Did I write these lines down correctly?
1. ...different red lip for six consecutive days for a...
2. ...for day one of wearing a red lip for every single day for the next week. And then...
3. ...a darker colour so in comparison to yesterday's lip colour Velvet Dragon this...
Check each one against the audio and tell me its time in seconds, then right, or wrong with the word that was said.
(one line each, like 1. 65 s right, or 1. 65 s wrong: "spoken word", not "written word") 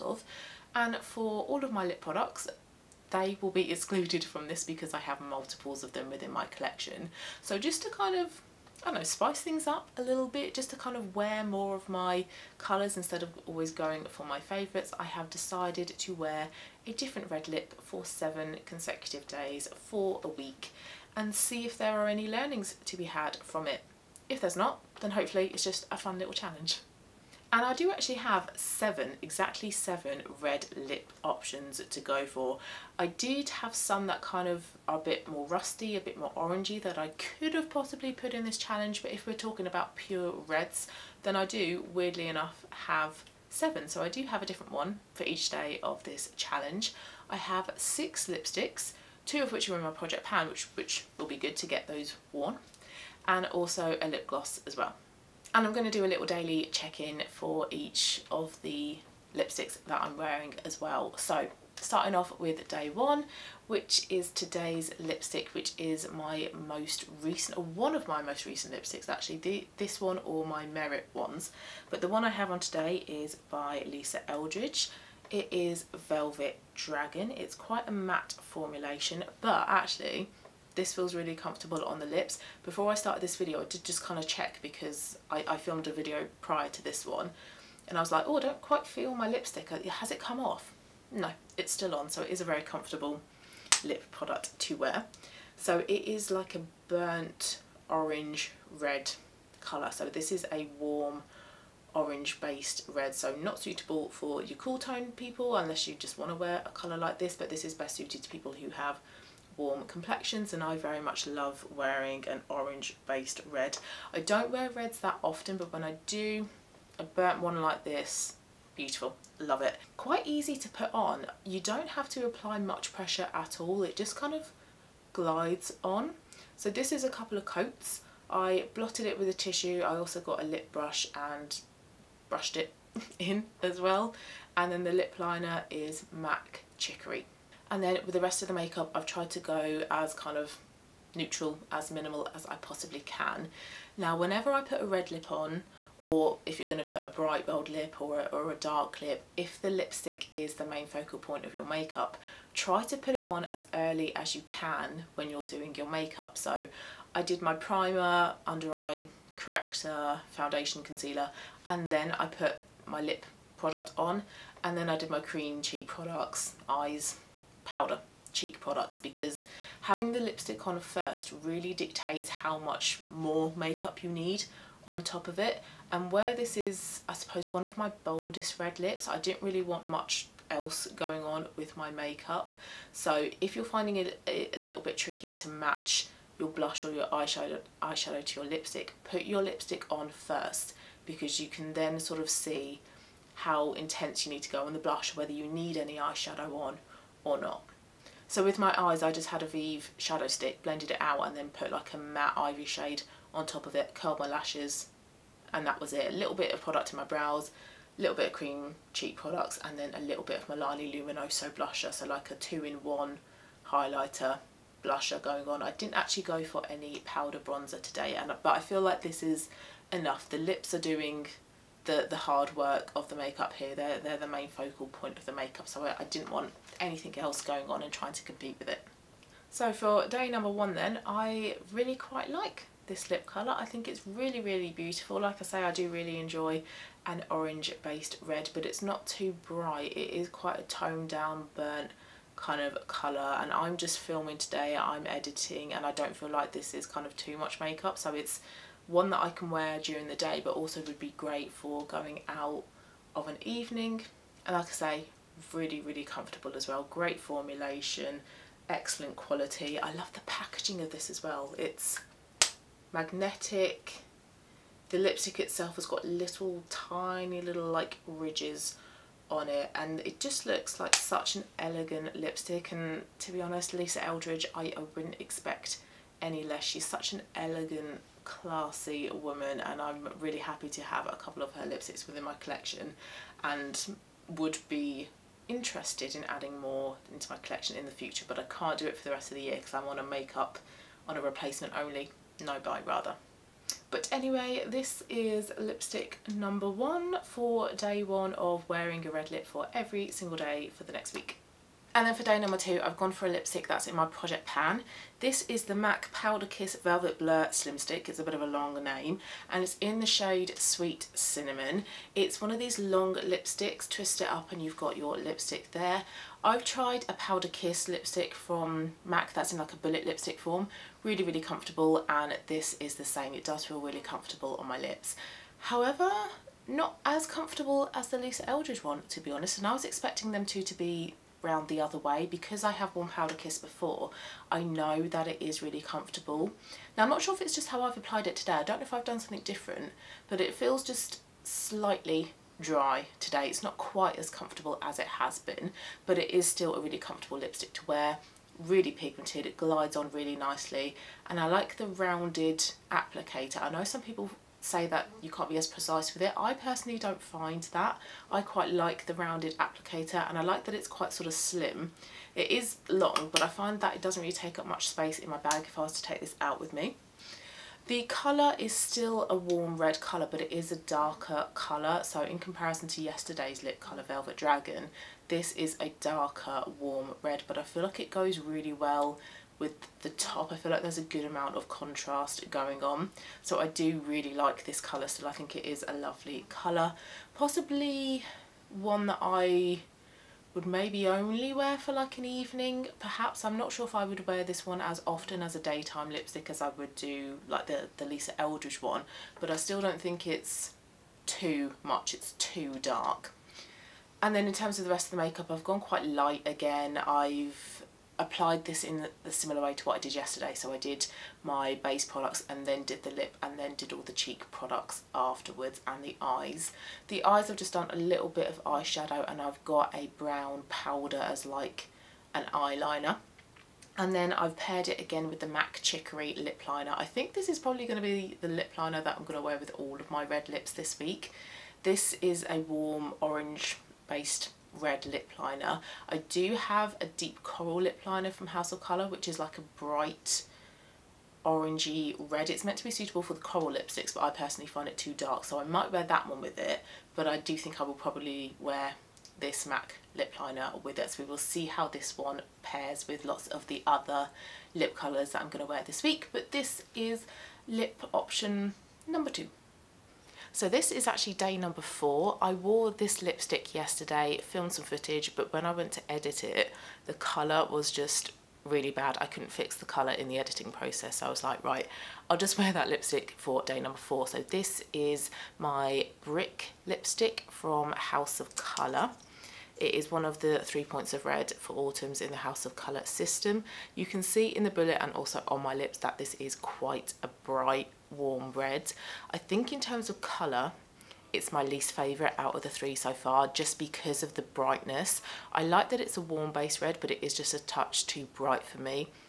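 1. 16 s wrong: "seven", not "six"
2. 297 s right
3. 370 s right.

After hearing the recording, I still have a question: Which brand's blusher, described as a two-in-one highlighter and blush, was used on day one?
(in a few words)
Milani.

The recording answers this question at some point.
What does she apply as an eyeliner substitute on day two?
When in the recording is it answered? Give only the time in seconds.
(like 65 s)
420 s.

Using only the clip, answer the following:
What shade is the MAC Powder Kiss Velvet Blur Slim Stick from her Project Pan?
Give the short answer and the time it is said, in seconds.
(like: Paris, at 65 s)
Sweet Cinnamon, at 310 s.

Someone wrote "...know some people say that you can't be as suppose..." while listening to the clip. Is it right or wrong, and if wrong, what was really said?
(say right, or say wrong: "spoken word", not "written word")
wrong: "precise", not "suppose".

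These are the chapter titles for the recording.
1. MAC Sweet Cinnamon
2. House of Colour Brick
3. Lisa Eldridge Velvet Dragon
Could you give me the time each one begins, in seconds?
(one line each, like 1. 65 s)
1. 301 s
2. 459 s
3. 61 s.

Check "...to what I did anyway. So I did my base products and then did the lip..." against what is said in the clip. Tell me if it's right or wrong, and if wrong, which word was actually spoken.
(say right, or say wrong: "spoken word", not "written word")
wrong: "yesterday", not "anyway".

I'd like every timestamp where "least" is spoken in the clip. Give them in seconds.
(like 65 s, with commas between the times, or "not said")
491 s.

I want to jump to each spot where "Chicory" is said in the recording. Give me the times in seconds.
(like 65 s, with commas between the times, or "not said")
136 s, 425 s.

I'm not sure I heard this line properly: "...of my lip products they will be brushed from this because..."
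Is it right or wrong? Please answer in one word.
wrong.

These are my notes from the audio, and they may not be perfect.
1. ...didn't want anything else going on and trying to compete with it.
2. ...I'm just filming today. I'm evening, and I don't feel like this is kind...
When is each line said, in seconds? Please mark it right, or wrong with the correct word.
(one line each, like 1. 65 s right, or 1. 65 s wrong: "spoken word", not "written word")
1. 226 s right
2. 243 s wrong: "editing", not "evening".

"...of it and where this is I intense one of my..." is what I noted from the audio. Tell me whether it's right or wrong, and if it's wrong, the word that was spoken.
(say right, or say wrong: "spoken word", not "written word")
wrong: "suppose", not "intense".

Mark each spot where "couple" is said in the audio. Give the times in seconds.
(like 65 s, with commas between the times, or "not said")
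127 s, 281 s.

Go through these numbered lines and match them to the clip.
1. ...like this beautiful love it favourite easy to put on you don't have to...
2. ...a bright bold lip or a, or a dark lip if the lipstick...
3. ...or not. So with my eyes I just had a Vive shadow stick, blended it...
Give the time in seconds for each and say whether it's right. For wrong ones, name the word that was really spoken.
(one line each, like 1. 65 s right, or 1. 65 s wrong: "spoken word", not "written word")
1. 117 s wrong: "quite", not "favourite"
2. 147 s right
3. 197 s right.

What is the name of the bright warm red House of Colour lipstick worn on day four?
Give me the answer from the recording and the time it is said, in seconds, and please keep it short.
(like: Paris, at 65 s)
Brick, at 476 s.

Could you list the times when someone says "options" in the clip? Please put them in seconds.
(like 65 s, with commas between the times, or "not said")
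31 s, 458 s.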